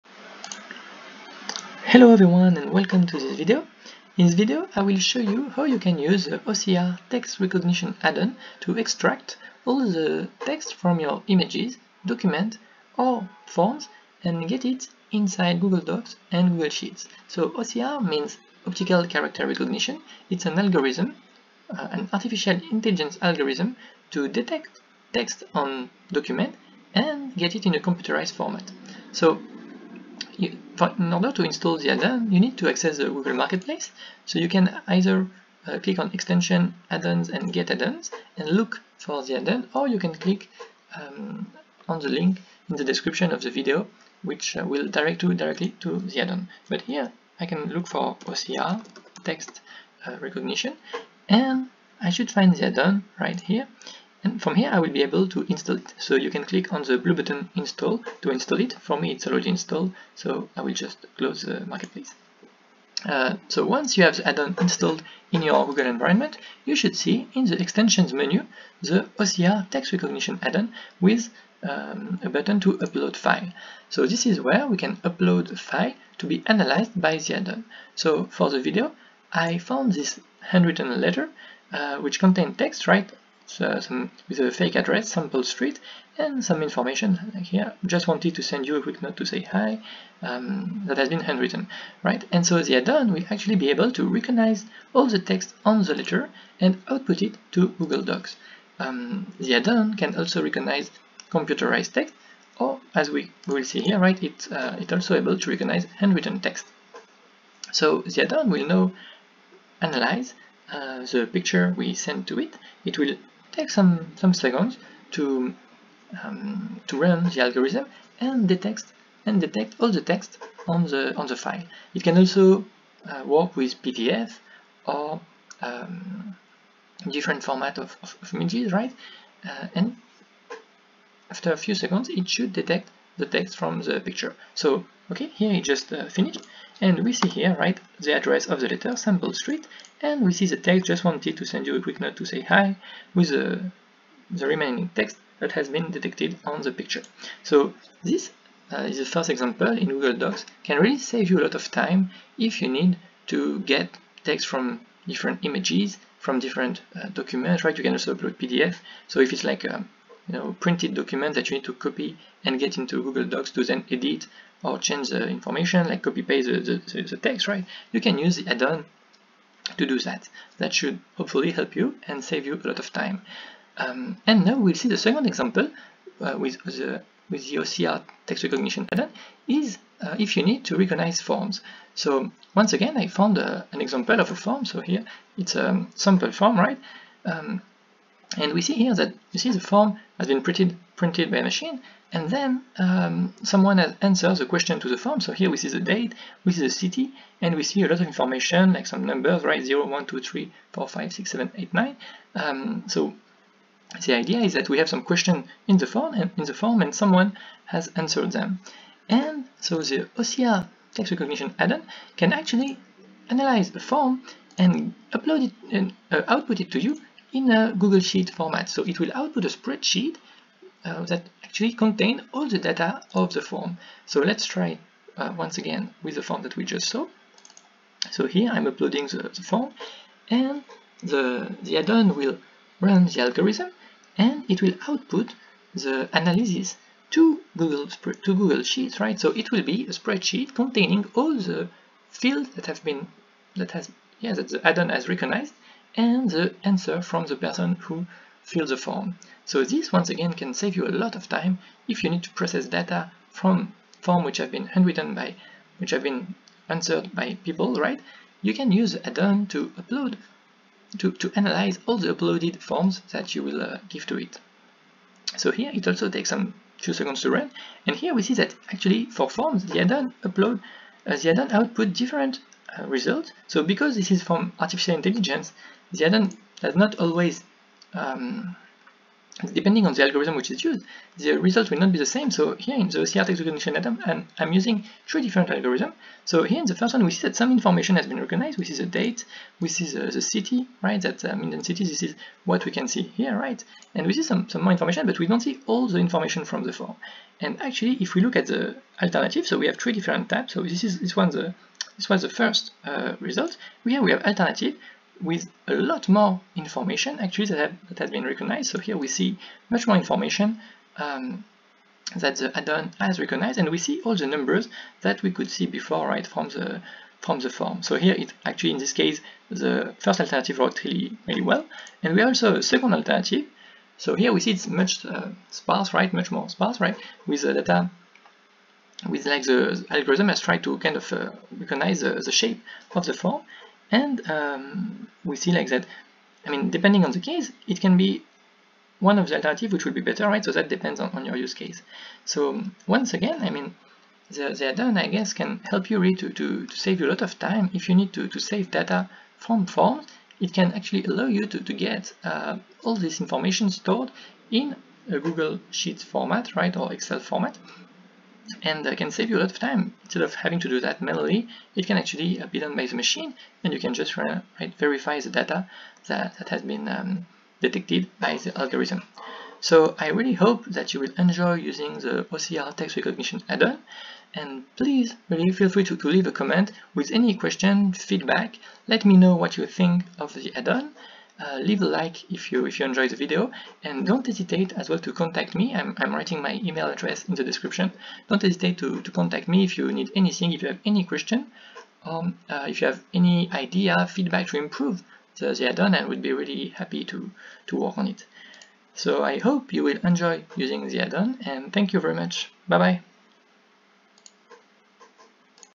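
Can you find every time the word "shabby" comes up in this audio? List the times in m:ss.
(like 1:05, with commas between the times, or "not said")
not said.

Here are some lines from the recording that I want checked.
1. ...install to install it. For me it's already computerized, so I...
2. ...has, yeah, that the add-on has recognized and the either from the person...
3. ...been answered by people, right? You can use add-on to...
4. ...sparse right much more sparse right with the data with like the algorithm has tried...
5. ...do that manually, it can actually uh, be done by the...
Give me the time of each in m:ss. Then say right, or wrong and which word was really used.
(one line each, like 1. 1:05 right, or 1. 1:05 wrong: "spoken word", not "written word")
1. 0:57 wrong: "installed", not "computerized"
2. 4:03 wrong: "answer", not "either"
3. 4:16 right
4. 5:25 right
5. 6:00 right.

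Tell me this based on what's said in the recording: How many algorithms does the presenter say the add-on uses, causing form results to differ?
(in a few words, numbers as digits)
3.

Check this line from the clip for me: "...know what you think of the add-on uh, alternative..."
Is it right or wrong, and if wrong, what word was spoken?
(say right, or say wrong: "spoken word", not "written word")
wrong: "leave", not "alternative".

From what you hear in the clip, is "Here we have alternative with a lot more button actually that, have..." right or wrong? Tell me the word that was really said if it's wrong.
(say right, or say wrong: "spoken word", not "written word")
wrong: "information", not "button".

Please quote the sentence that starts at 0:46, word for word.
But here, I can look for OCR, text uh, recognition, and I should find the add-on right here.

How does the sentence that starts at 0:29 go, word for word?
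So in order to install the add-on, you need to access the Google Marketplace.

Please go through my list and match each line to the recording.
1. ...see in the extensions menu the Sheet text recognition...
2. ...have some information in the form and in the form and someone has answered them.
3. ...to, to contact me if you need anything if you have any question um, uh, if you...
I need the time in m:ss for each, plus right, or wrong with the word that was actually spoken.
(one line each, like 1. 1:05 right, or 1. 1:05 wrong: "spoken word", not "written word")
1. 1:06 wrong: "OCR", not "Sheet"
2. 3:24 wrong: "question", not "information"
3. 6:28 right.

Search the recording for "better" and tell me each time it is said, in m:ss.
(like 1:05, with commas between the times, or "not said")
5:40.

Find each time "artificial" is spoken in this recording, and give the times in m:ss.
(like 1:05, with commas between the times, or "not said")
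0:22, 4:34.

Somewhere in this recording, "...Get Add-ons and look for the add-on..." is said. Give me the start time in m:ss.
0:37.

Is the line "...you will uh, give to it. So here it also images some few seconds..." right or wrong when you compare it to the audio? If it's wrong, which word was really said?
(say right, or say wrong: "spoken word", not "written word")
wrong: "takes", not "images".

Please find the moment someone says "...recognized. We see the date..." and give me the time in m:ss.
4:48.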